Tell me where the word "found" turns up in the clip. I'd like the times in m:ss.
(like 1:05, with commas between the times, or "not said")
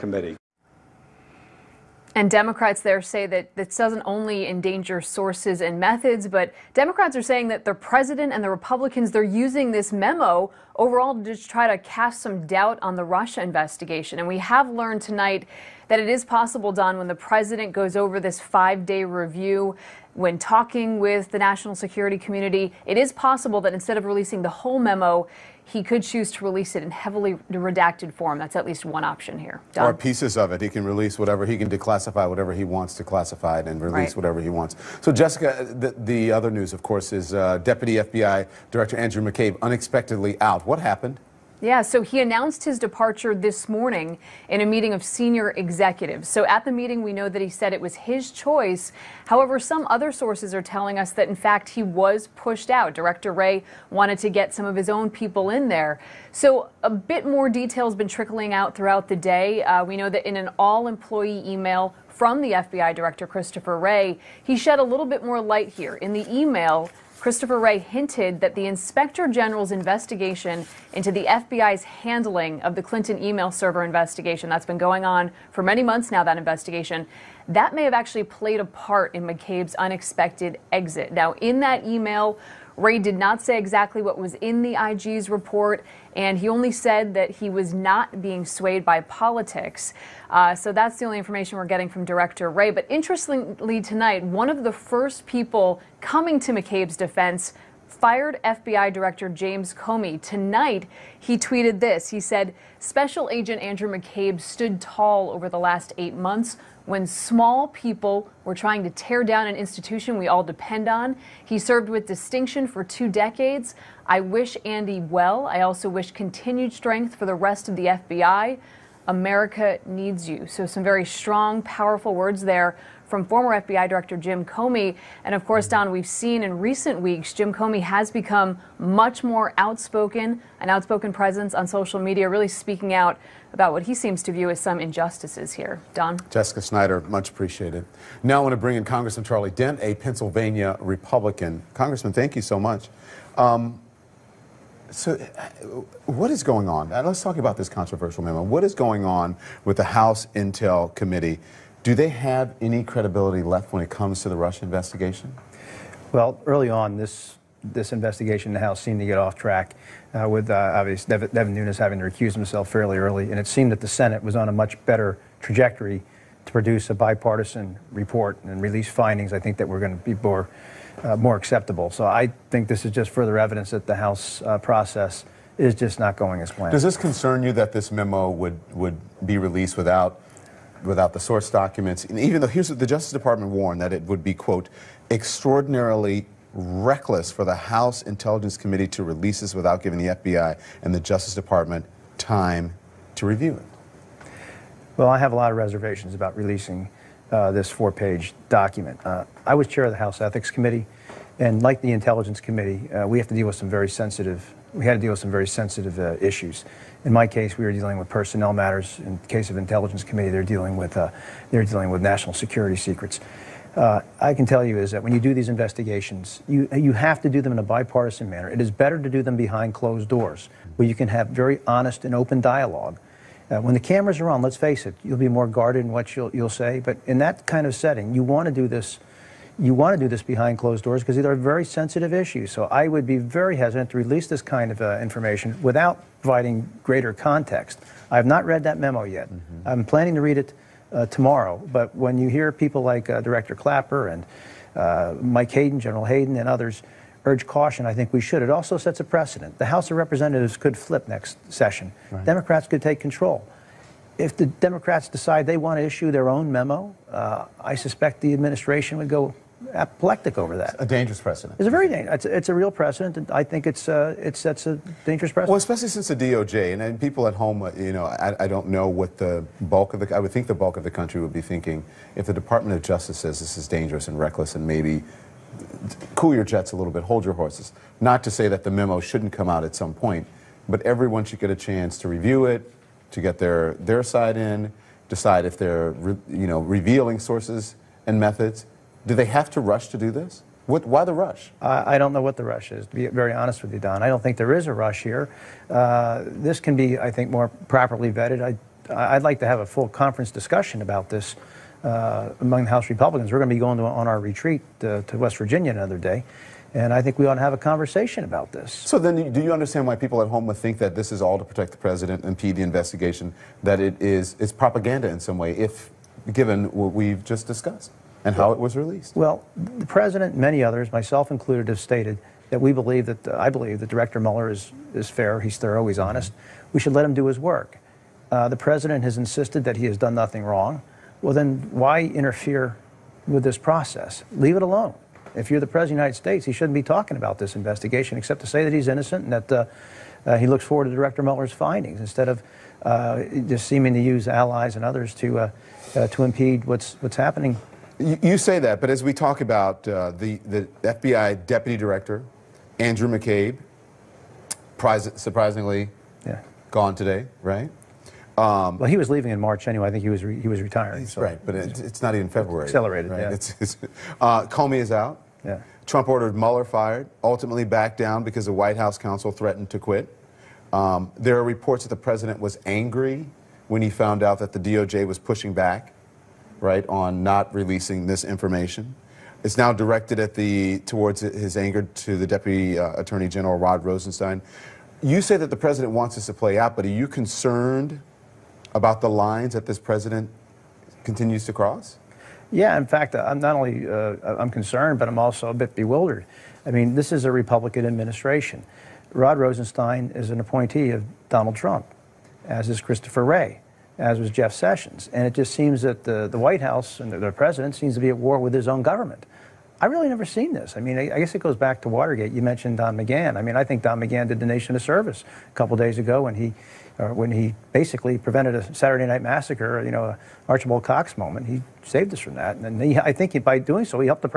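6:13.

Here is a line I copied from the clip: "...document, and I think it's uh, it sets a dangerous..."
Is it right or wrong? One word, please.
wrong.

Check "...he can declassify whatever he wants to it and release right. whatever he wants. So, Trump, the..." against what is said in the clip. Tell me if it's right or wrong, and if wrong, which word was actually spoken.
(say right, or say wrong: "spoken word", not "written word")
wrong: "Jessica", not "Trump".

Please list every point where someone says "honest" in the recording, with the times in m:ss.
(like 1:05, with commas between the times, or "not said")
3:41, 4:53, 5:25.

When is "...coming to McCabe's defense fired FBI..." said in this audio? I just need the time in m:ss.
1:36.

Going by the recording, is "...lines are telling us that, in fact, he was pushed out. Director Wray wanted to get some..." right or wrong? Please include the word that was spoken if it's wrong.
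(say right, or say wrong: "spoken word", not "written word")
wrong: "sources", not "lines".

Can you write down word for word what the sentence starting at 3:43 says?
Uh, when the cameras are on, let's face it, you'll be more guarded in what you'll you'll say.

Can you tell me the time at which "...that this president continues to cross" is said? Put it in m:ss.
6:29.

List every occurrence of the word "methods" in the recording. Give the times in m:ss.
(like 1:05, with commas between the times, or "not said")
0:05, 4:48.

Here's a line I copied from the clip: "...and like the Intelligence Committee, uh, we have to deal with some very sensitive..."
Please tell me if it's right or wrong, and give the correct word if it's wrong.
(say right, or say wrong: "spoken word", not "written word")
right.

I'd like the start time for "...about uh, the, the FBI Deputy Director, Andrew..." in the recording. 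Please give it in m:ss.
5:49.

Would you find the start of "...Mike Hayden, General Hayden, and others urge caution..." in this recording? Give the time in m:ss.
4:05.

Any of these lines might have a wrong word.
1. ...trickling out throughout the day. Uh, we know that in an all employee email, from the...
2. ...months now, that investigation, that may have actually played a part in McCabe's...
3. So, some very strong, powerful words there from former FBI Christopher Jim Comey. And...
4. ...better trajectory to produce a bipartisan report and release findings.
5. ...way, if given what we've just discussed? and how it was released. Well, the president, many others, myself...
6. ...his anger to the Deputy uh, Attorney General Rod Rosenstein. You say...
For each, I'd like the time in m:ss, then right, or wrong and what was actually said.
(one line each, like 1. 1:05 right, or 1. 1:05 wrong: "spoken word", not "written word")
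1. 0:58 right
2. 1:15 right
3. 2:00 wrong: "Director", not "Christopher"
4. 2:44 right
5. 5:15 right
6. 6:21 right.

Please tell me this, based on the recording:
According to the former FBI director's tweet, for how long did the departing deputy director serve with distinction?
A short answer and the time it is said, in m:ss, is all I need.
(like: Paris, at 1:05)
two decades, at 1:52.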